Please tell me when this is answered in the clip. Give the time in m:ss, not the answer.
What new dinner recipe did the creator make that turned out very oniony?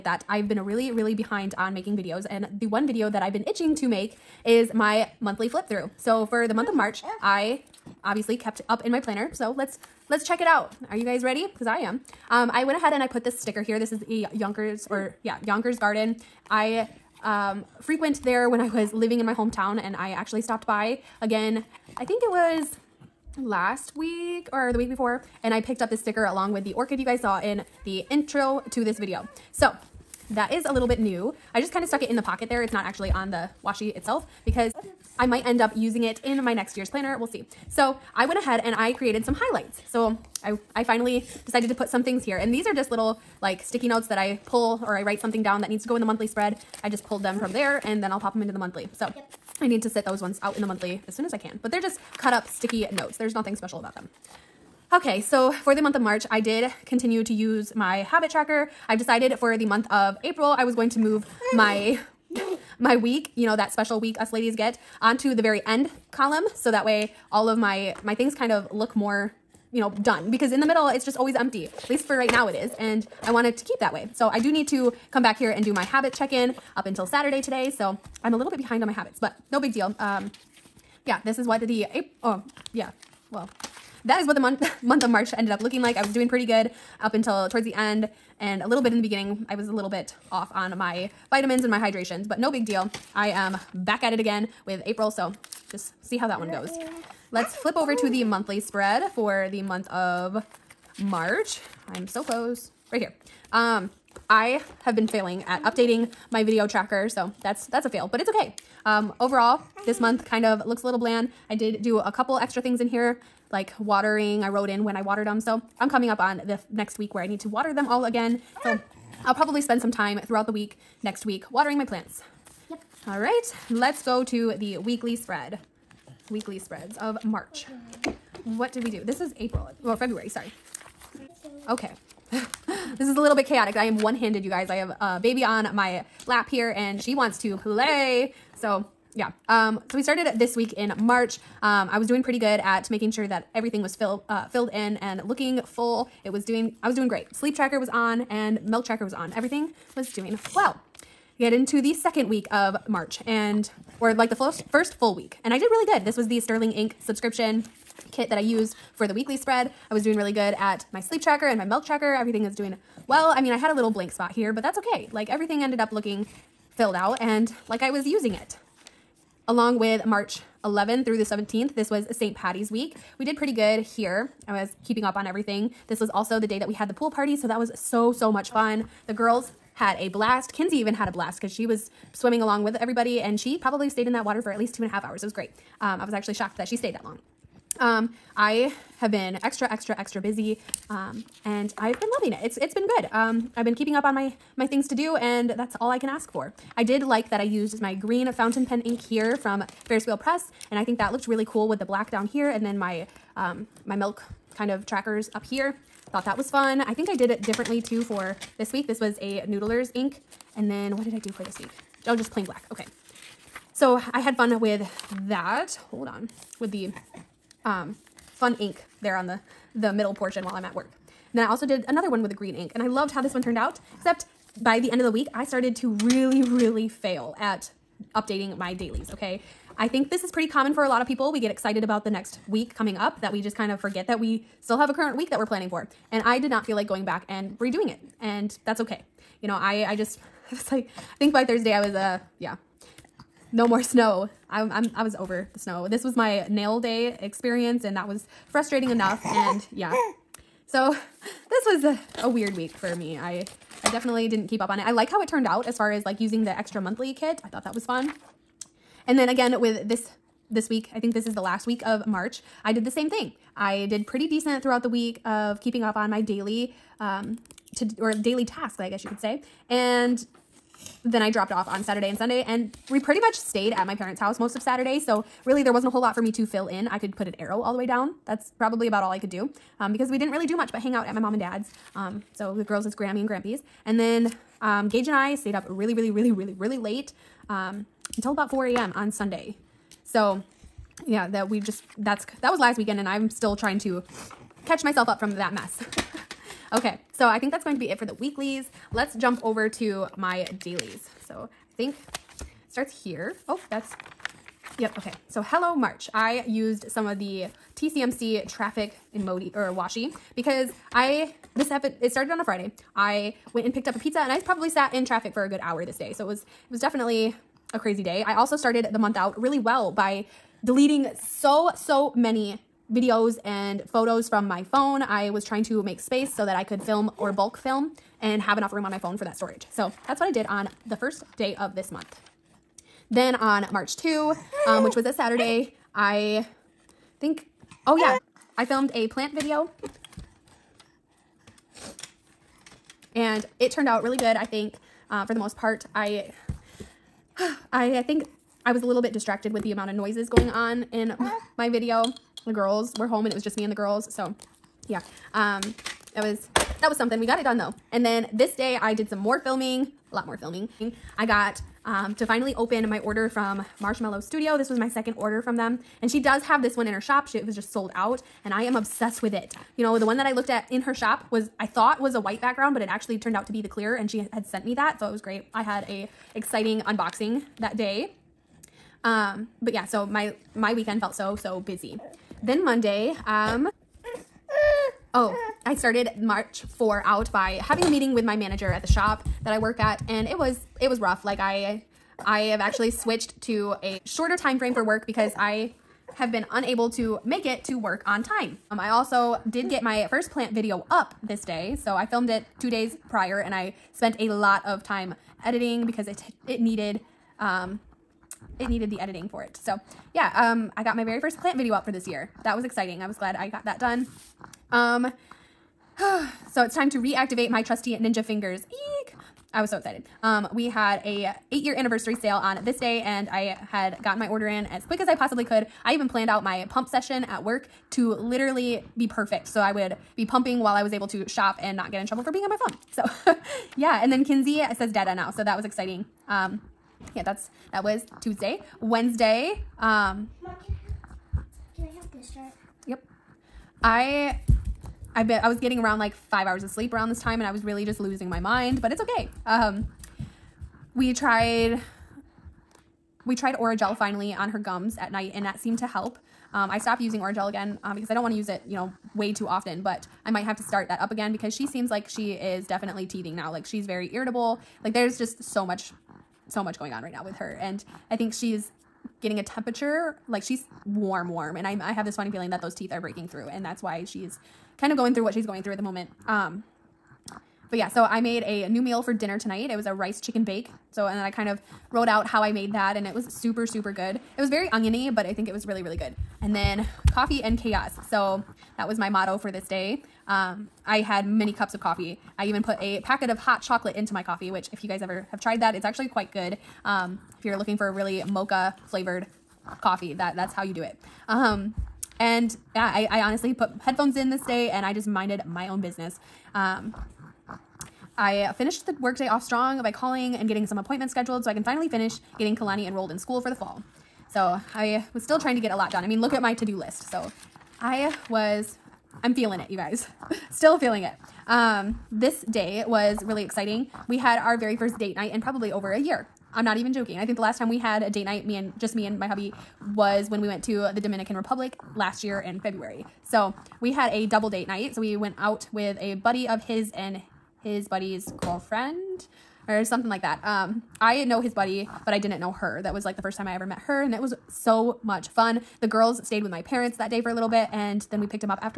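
7:59.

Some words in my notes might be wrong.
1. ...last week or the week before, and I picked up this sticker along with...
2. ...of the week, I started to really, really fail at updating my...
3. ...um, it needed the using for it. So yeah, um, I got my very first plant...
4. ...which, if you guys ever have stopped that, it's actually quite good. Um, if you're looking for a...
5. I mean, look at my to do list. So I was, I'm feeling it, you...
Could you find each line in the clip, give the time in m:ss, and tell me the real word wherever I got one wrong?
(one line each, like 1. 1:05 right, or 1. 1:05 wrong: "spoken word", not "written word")
1. 0:23 right
2. 3:44 right
3. 6:47 wrong: "editing", not "using"
4. 8:14 wrong: "tried", not "stopped"
5. 8:36 right.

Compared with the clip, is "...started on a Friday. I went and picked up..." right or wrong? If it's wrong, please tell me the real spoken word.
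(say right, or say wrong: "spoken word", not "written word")
right.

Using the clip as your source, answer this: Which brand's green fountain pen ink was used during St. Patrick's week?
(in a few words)
Ferris Wheel Press.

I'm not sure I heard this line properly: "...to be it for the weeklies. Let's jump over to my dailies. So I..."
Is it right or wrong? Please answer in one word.
right.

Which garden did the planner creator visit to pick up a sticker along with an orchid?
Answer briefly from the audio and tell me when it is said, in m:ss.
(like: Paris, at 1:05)
Yonkers Garden, at 0:15.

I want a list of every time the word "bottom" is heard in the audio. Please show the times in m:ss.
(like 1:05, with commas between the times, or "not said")
not said.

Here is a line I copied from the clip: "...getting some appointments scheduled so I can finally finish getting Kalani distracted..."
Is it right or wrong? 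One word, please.
wrong.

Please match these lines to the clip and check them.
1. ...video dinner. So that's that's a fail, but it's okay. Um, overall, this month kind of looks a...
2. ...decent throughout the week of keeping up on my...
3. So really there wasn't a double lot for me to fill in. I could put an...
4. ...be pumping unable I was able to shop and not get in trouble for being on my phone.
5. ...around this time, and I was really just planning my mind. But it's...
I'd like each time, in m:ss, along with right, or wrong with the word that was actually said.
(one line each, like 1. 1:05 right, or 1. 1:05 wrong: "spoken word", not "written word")
1. 1:46 wrong: "tracker", not "dinner"
2. 4:24 right
3. 4:34 wrong: "whole", not "double"
4. 7:10 wrong: "while", not "unable"
5. 7:26 wrong: "losing", not "planning".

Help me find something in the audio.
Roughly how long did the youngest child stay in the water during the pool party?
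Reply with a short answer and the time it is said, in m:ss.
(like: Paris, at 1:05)
two and a half hours, at 3:04.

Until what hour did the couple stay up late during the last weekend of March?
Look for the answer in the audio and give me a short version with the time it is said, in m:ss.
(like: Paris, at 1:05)
4 a.m., at 4:48.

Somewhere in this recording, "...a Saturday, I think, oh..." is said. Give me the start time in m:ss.
5:35.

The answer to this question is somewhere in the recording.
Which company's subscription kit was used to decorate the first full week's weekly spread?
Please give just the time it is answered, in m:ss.
2:36.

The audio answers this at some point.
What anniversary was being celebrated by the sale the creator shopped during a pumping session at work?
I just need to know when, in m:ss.
7:01.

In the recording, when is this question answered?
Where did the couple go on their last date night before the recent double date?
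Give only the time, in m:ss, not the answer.
8:50.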